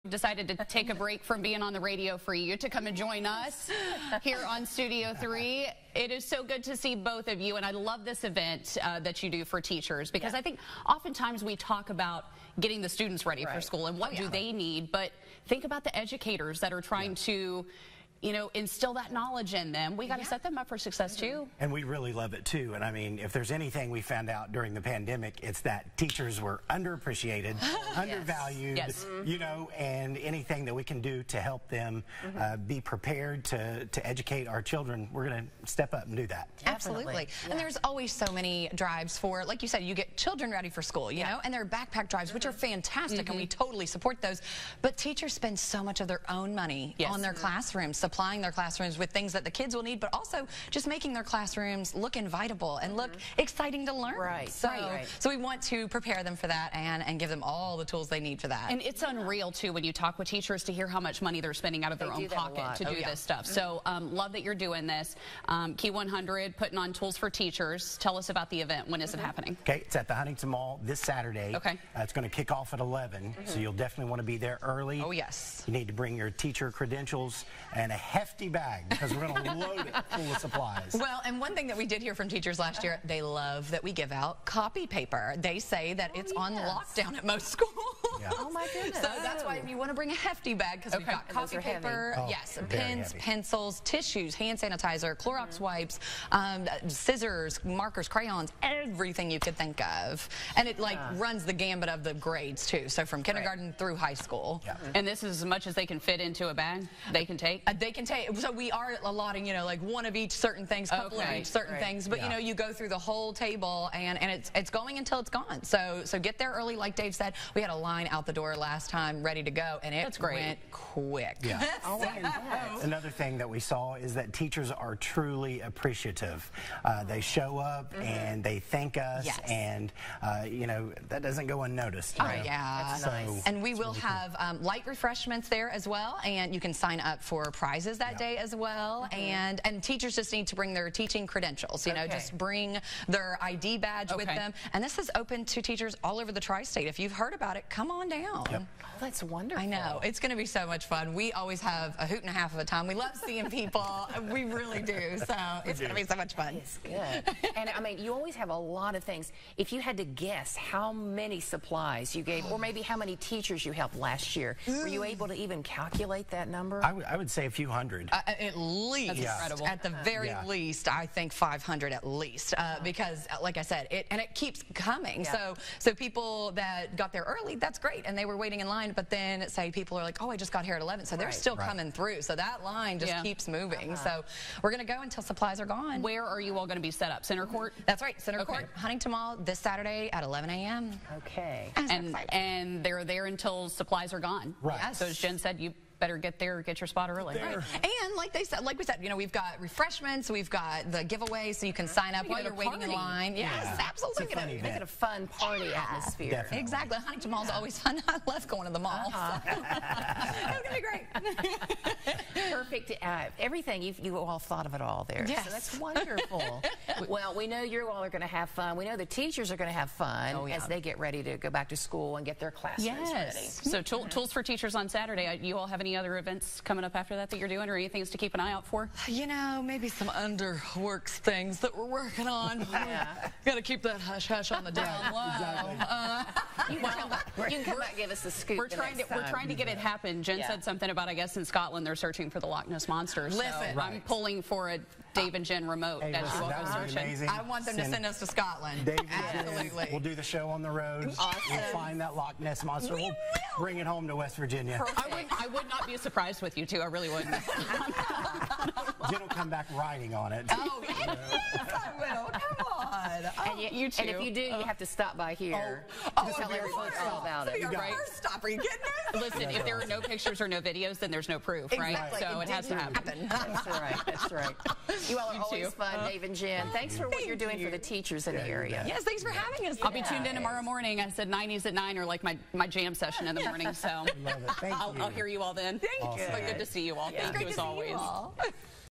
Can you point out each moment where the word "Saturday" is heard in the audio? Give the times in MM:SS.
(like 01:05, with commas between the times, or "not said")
01:11, 03:09, 03:44.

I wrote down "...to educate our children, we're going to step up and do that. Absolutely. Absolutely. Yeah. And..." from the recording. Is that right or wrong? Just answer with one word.
right.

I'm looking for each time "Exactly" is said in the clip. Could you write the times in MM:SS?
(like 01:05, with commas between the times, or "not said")
03:26, 03:55, 04:31.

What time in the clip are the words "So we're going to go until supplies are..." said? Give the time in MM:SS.
03:04.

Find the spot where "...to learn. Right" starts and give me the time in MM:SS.
00:53.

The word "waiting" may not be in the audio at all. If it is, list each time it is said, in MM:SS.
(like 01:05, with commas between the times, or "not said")
02:58, 03:22.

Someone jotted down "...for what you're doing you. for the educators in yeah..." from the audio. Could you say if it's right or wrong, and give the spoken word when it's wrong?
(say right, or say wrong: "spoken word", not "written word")
wrong: "teachers", not "educators".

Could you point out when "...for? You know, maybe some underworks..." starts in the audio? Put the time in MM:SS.
03:48.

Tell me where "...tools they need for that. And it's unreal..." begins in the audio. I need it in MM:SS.
00:57.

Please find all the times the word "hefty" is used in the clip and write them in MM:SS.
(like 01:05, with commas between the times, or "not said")
01:18, 01:30.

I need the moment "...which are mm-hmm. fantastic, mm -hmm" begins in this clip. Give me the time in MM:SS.
00:42.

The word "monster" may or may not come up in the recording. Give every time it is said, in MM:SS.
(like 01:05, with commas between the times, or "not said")
04:02, 04:12.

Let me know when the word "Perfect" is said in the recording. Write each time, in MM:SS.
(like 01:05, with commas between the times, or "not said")
03:32.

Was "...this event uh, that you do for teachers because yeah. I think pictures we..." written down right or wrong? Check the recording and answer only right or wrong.
wrong.